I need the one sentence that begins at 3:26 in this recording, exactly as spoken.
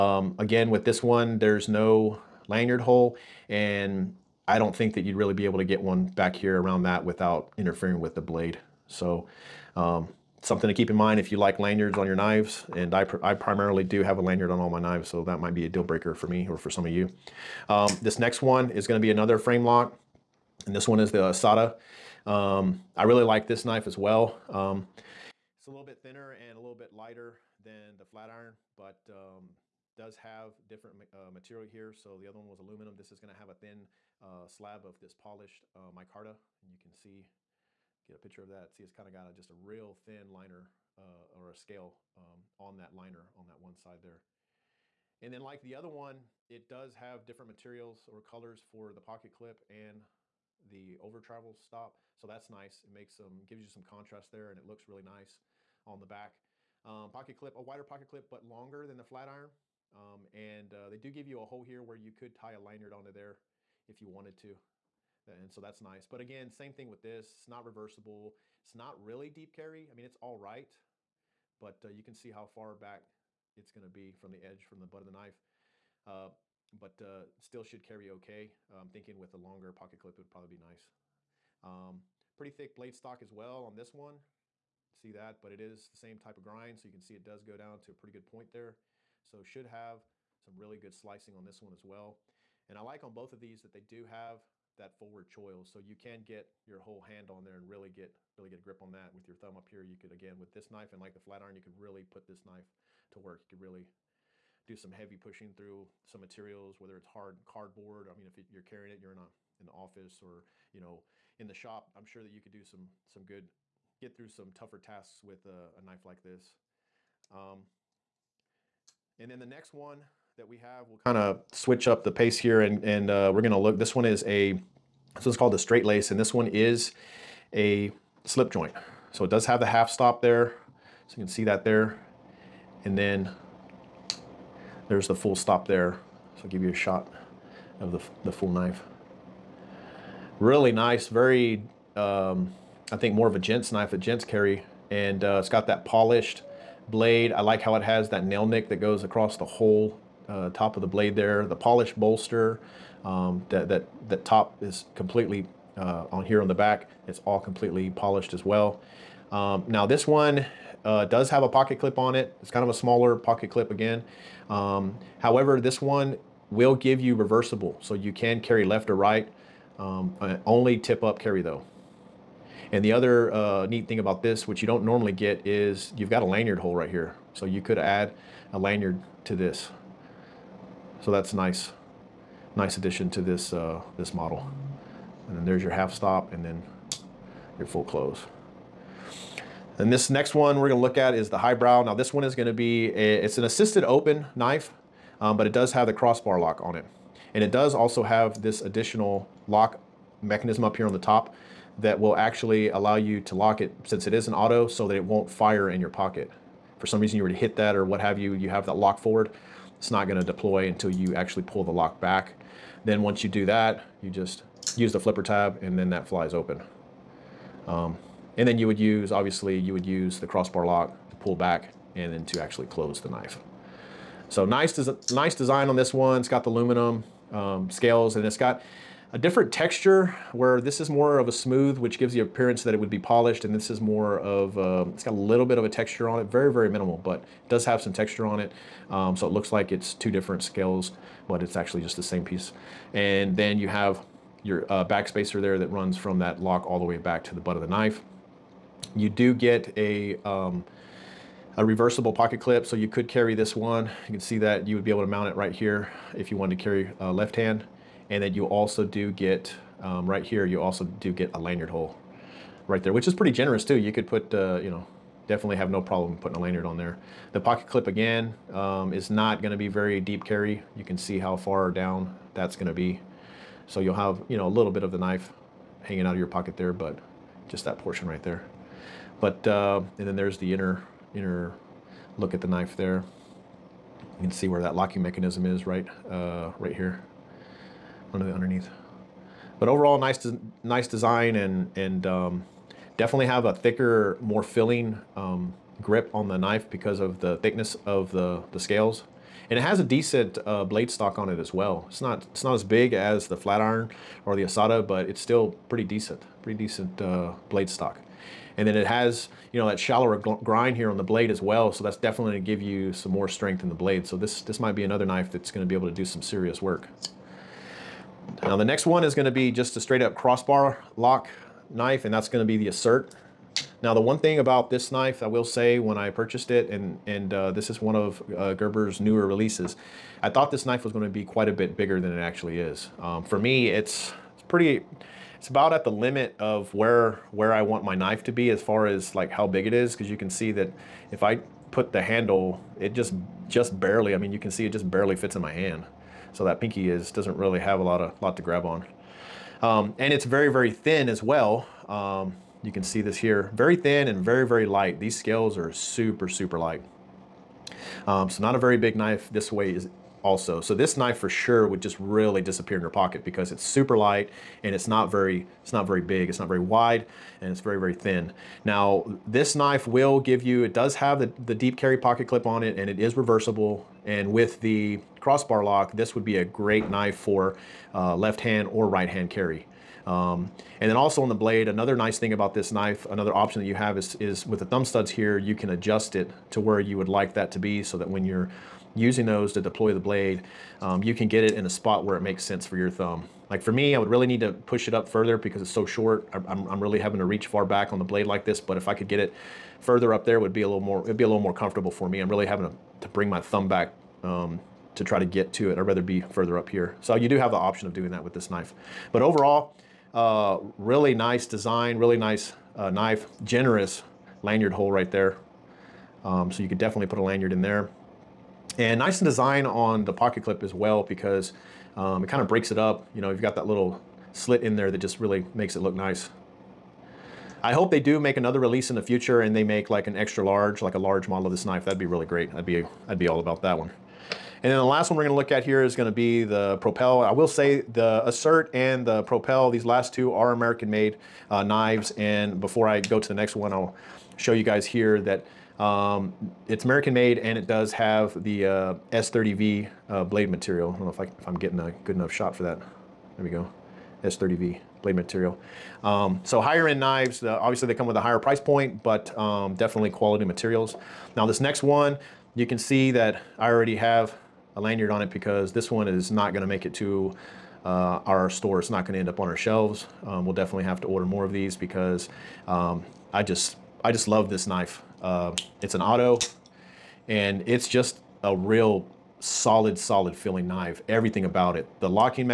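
For some reason you were to hit that or what have you, you have that lock forward.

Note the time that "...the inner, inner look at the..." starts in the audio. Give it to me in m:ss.
4:40.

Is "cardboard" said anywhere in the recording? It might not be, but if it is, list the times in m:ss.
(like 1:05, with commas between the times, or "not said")
1:47.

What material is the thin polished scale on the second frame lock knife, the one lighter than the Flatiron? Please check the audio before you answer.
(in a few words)
Micarta.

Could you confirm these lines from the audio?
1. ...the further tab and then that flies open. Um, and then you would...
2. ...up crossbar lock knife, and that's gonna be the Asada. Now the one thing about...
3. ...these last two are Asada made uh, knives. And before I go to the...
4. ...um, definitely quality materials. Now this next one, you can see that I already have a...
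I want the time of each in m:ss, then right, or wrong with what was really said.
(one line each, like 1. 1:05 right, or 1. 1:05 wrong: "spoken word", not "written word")
1. 3:34 wrong: "flipper", not "further"
2. 5:20 wrong: "Assert", not "Asada"
3. 7:19 wrong: "American", not "Asada"
4. 7:39 right.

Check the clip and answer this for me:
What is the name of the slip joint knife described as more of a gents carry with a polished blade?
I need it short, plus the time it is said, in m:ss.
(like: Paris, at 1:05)
Straightlace, at 2:05.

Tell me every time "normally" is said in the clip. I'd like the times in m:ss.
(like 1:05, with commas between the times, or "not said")
2:54.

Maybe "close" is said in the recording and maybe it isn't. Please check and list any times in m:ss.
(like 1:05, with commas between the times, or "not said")
3:07, 3:42.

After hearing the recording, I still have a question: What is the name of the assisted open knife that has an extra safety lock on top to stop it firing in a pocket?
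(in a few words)
Highbrow.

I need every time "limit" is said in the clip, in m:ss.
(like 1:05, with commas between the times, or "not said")
5:35.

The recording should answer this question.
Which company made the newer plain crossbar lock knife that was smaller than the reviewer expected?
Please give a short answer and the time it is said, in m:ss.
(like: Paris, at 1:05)
Gerber, at 5:28.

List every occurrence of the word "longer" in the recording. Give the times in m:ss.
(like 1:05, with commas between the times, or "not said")
0:58, 1:19.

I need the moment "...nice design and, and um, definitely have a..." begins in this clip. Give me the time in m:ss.
4:50.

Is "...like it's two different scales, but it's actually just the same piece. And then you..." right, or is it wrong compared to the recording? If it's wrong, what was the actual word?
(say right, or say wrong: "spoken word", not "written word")
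right.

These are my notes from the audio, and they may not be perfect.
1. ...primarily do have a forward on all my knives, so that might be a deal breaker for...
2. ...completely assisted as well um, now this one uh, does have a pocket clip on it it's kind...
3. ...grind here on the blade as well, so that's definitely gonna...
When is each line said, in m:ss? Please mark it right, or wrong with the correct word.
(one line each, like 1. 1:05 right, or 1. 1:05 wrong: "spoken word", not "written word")
1. 0:13 wrong: "lanyard", not "forward"
2. 2:37 wrong: "polished", not "assisted"
3. 5:10 right.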